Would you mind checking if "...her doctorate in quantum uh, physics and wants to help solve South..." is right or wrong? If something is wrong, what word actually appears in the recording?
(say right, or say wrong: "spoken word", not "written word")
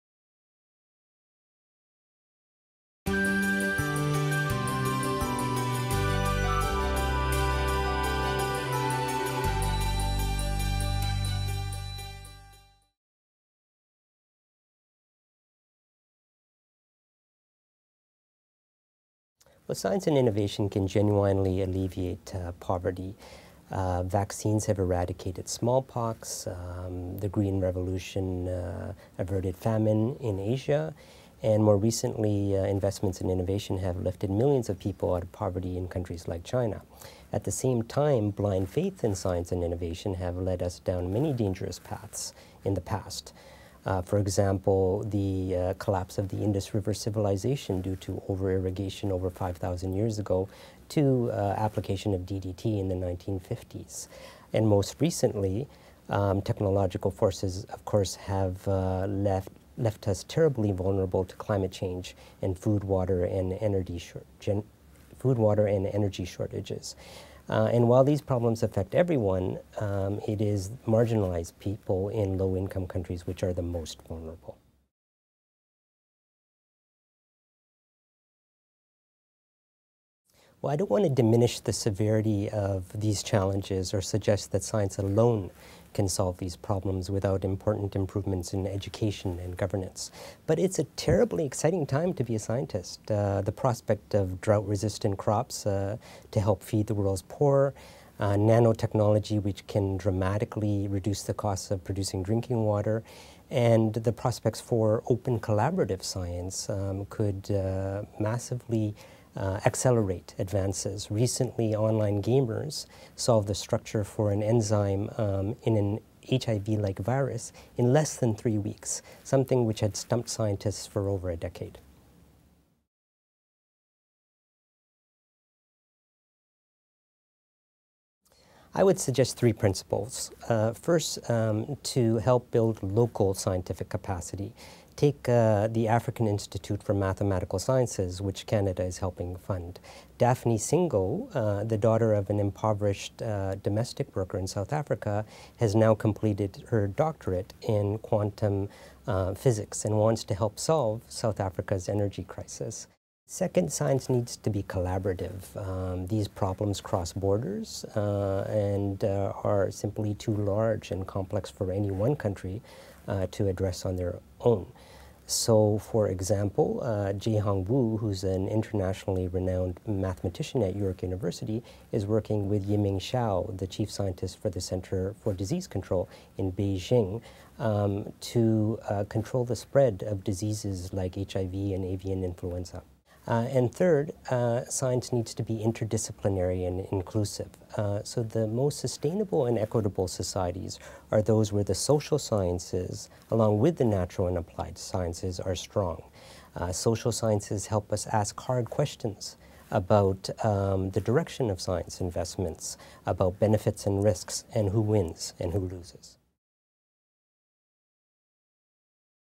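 right.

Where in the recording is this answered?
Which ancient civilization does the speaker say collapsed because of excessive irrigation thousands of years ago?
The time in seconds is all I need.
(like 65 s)
46 s.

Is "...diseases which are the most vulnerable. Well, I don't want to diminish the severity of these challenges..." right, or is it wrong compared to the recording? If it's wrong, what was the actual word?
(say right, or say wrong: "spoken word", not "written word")
wrong: "countries", not "diseases".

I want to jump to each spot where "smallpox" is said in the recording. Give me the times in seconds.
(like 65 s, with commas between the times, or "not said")
25 s.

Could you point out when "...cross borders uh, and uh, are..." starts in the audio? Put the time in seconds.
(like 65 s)
156 s.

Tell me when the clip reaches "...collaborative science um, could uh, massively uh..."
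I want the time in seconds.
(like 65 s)
105 s.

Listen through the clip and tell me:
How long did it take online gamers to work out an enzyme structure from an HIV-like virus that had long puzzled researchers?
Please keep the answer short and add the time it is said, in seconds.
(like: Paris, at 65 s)
less than 3 weeks, at 117 s.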